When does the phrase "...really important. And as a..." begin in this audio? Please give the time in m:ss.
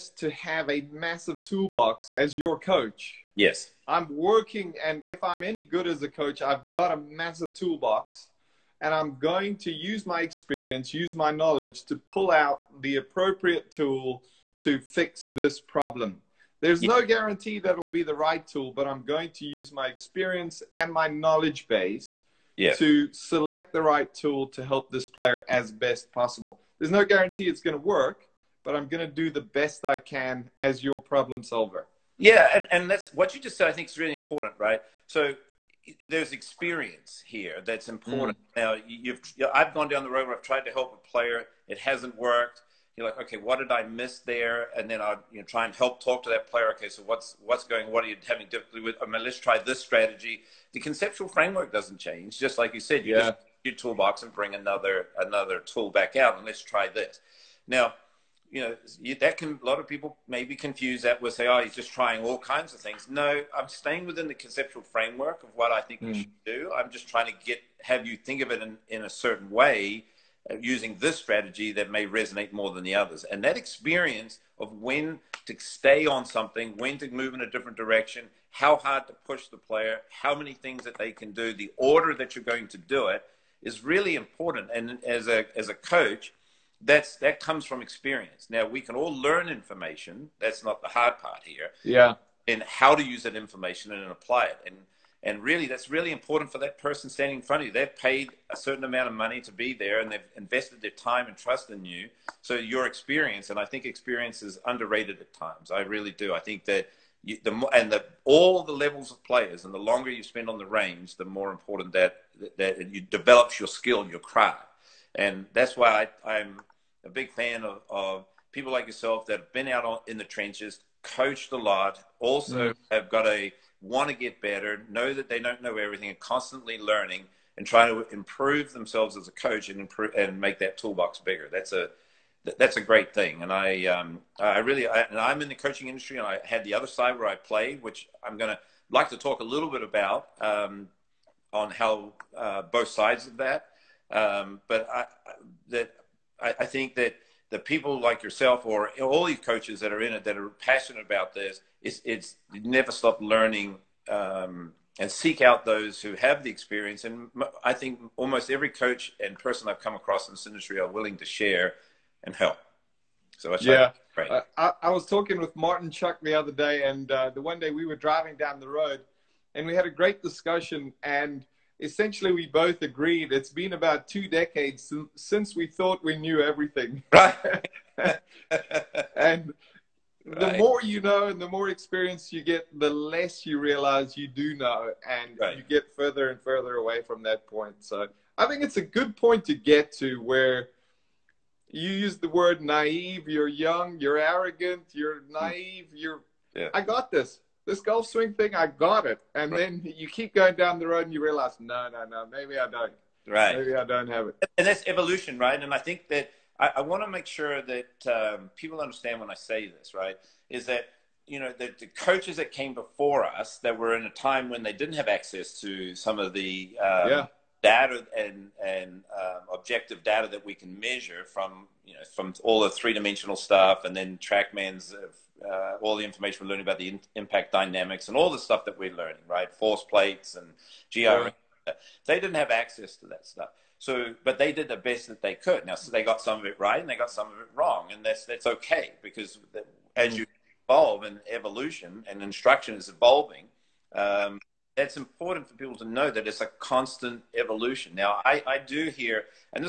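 1:23.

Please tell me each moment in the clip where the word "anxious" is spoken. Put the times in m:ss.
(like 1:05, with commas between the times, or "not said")
not said.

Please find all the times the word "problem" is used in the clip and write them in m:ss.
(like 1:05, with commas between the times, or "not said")
0:15, 0:30.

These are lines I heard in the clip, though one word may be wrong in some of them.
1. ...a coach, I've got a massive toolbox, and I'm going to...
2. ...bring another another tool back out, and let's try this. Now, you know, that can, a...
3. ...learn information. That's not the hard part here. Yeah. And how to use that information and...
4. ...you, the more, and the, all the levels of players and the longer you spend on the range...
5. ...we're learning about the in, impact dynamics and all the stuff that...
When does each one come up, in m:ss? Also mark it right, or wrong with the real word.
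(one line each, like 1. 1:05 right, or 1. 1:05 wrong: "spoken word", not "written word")
1. 0:06 right
2. 0:54 right
3. 1:29 right
4. 1:47 right
5. 3:46 right.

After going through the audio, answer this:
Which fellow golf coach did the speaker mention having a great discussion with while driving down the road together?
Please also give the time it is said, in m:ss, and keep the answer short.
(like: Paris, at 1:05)
Martin Chuck, at 2:45.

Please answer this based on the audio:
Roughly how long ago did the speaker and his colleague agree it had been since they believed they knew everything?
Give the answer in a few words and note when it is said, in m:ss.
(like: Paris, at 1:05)
2 decades, at 2:53.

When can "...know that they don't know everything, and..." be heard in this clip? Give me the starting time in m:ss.
2:04.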